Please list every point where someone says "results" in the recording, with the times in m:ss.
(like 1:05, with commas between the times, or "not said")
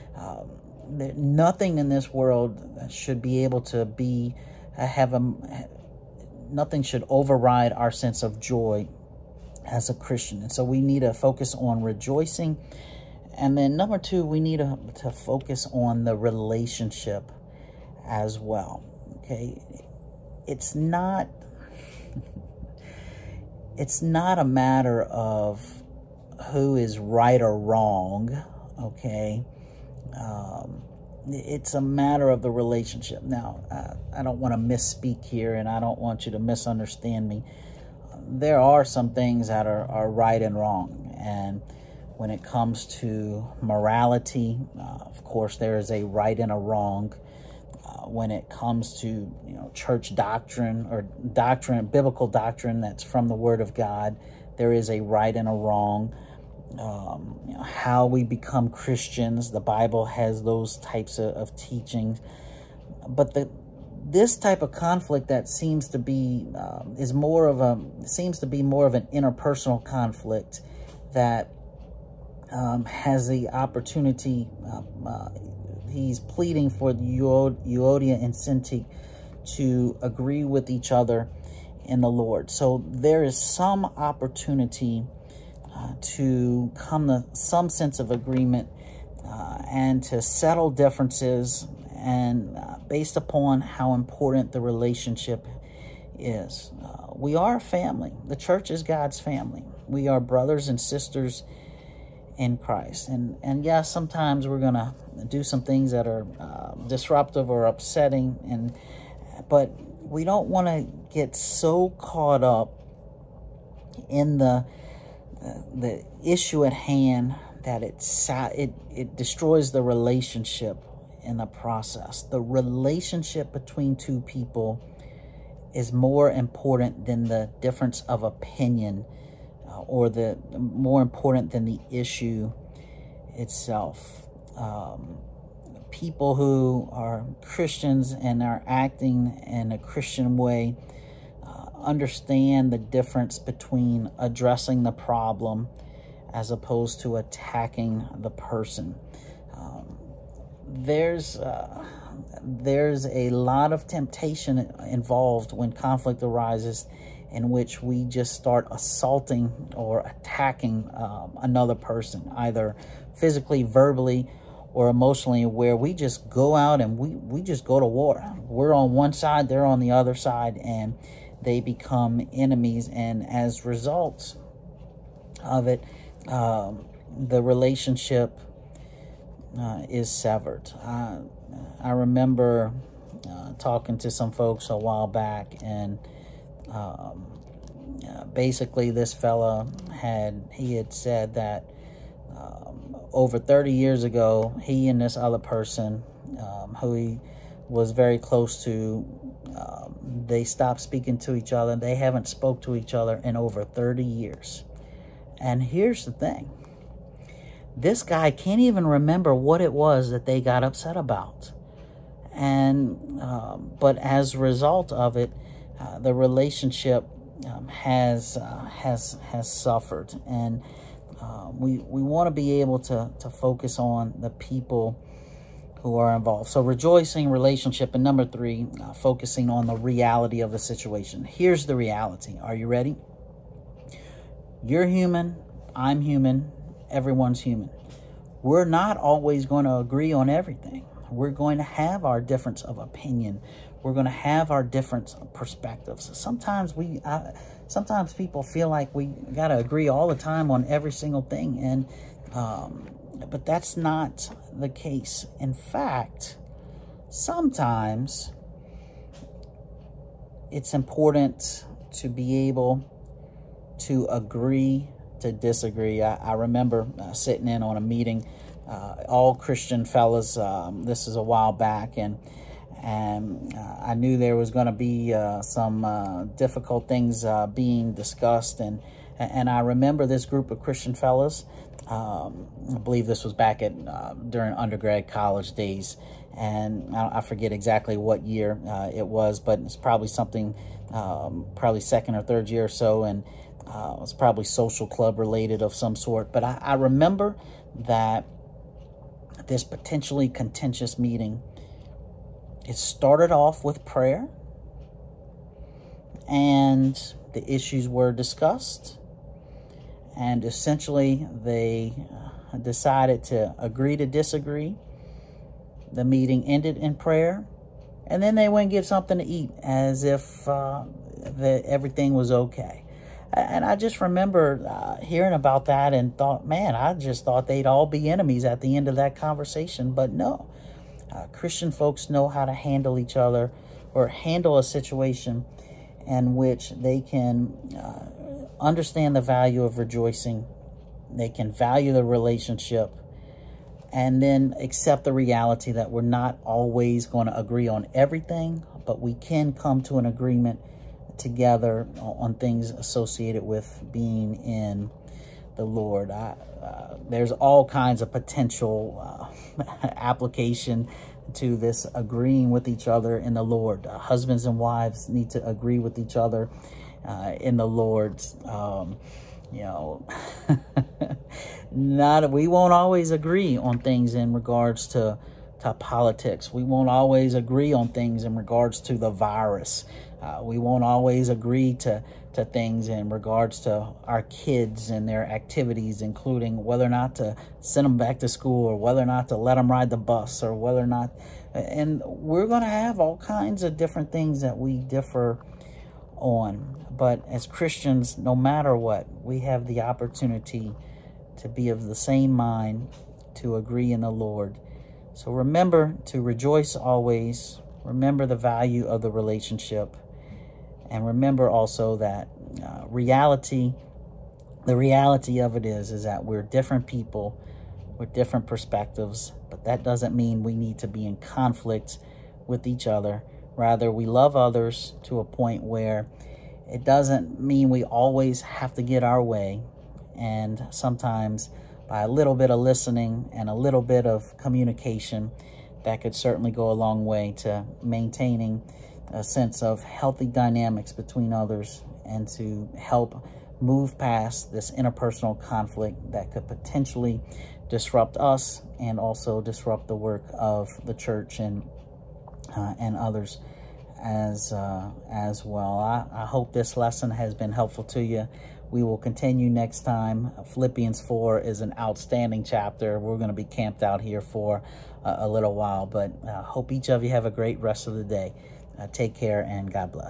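2:53, 3:34.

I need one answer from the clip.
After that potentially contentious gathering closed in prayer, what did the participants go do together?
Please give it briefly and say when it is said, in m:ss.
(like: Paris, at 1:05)
get something to eat, at 5:18.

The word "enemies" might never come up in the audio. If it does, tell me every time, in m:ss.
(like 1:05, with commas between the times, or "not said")
2:52, 5:28.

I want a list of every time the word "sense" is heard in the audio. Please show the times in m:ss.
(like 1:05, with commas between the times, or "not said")
0:07, 1:27, 7:19.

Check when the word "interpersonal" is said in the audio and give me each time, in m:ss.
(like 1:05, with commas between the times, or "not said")
1:09, 7:24.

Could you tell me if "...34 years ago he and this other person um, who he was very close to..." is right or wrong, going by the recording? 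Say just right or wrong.
wrong.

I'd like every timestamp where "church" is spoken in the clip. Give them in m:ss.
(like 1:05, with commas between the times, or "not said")
0:49, 1:38, 7:30.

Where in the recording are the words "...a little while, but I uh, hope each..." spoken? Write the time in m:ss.
7:45.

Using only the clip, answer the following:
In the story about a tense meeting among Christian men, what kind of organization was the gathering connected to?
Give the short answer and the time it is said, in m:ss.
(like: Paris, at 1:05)
social club, at 4:54.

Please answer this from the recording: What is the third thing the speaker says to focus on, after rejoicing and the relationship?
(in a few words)
the reality of the situation.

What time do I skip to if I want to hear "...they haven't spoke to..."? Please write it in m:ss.
3:21.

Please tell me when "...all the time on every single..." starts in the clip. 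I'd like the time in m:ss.
4:09.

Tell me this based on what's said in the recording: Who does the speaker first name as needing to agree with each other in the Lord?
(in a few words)
husbands and wives.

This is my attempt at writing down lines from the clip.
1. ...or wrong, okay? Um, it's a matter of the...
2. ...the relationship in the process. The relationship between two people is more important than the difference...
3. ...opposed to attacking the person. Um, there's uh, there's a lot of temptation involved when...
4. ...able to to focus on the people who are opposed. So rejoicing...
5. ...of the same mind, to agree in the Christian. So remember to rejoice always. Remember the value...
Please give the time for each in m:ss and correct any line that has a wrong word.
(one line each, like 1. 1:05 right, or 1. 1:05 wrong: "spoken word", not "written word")
1. 0:27 right
2. 1:59 right
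3. 2:26 right
4. 3:42 wrong: "involved", not "opposed"
5. 6:41 wrong: "Lord", not "Christian".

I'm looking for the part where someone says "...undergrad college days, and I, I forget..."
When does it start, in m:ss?
4:44.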